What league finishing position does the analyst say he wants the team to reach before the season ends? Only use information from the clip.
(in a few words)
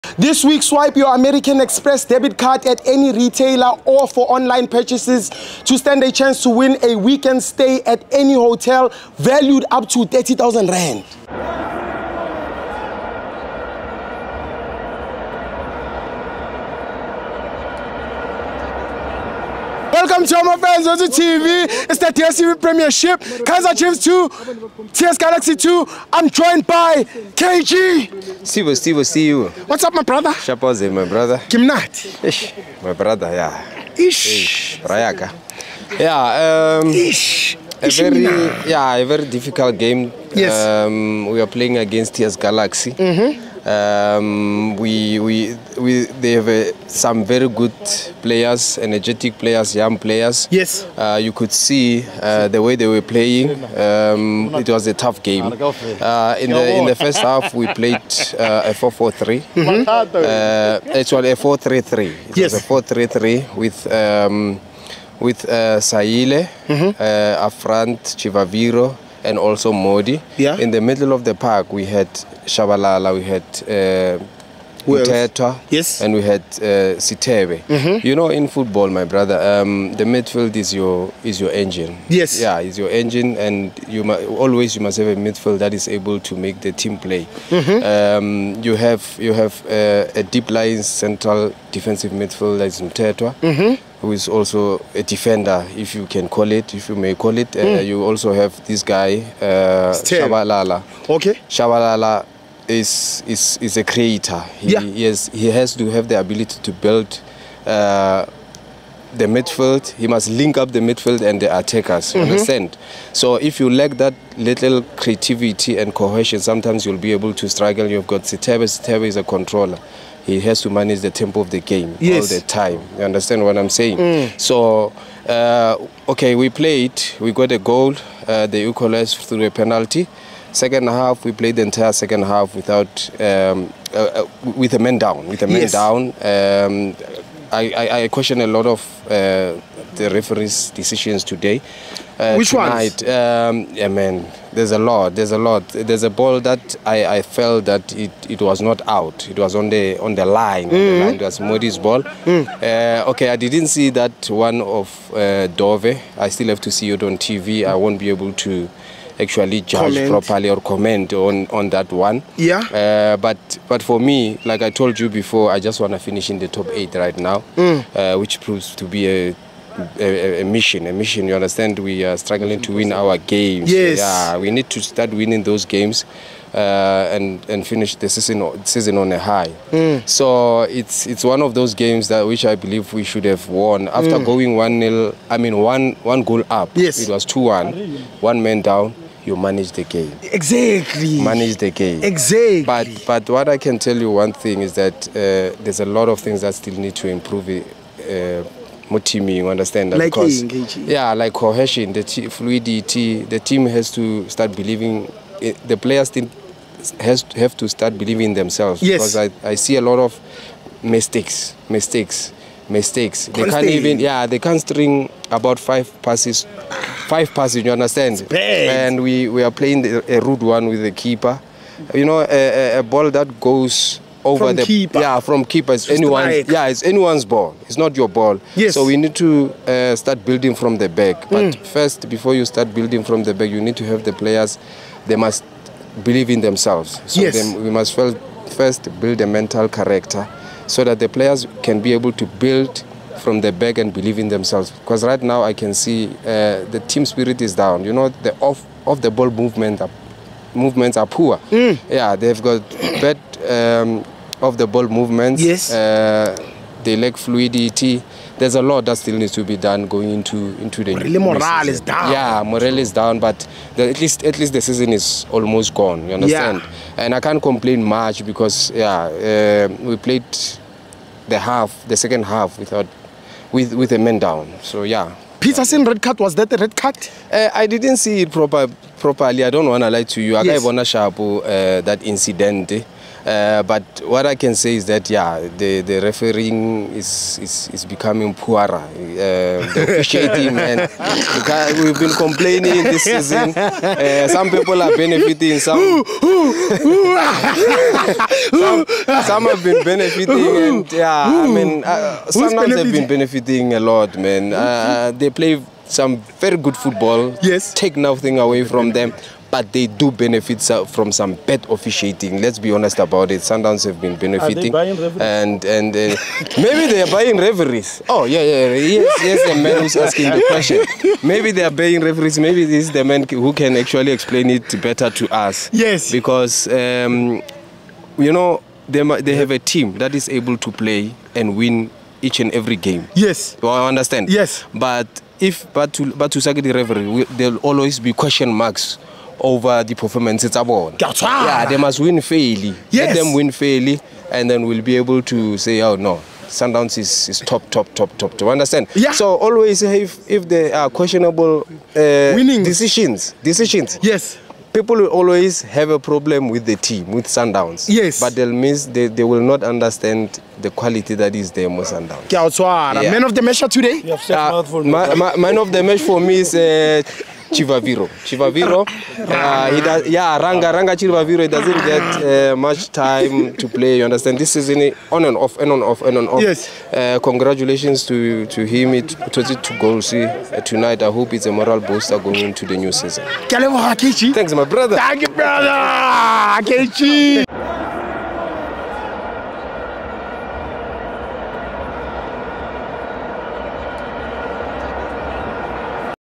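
Top eight.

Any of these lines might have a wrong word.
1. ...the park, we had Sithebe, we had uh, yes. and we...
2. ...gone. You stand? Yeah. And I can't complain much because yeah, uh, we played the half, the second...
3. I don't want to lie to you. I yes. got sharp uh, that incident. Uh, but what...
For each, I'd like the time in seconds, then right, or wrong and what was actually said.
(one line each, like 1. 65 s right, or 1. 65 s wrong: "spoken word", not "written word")
1. 71 s wrong: "Shabalala", not "Sithebe"
2. 265 s wrong: "understand", not "stand"
3. 279 s right.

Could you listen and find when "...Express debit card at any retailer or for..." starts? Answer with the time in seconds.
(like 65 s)
1 s.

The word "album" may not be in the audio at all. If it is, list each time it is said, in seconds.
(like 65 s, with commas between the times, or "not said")
not said.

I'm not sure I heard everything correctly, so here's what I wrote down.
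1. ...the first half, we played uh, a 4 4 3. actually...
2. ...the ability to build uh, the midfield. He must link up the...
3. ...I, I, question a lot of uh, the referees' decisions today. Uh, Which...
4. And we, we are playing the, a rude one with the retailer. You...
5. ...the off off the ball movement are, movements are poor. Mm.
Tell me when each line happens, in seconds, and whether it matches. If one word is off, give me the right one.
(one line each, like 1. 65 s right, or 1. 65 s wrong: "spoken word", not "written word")
1. 56 s right
2. 106 s right
3. 137 s right
4. 218 s wrong: "keeper", not "retailer"
5. 248 s right.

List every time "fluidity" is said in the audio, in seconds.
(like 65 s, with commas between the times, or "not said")
202 s, 257 s.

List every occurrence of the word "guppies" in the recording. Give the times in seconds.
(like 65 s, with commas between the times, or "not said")
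not said.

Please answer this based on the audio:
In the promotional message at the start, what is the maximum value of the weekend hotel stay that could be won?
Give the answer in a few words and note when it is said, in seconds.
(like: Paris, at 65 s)
30,000 Rand, at 10 s.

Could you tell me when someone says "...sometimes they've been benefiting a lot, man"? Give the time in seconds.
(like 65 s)
302 s.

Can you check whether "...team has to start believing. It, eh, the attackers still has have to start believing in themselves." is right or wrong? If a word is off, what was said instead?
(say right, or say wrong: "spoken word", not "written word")
wrong: "players", not "attackers".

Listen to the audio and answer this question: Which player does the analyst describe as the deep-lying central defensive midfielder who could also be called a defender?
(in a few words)
Mthethwa.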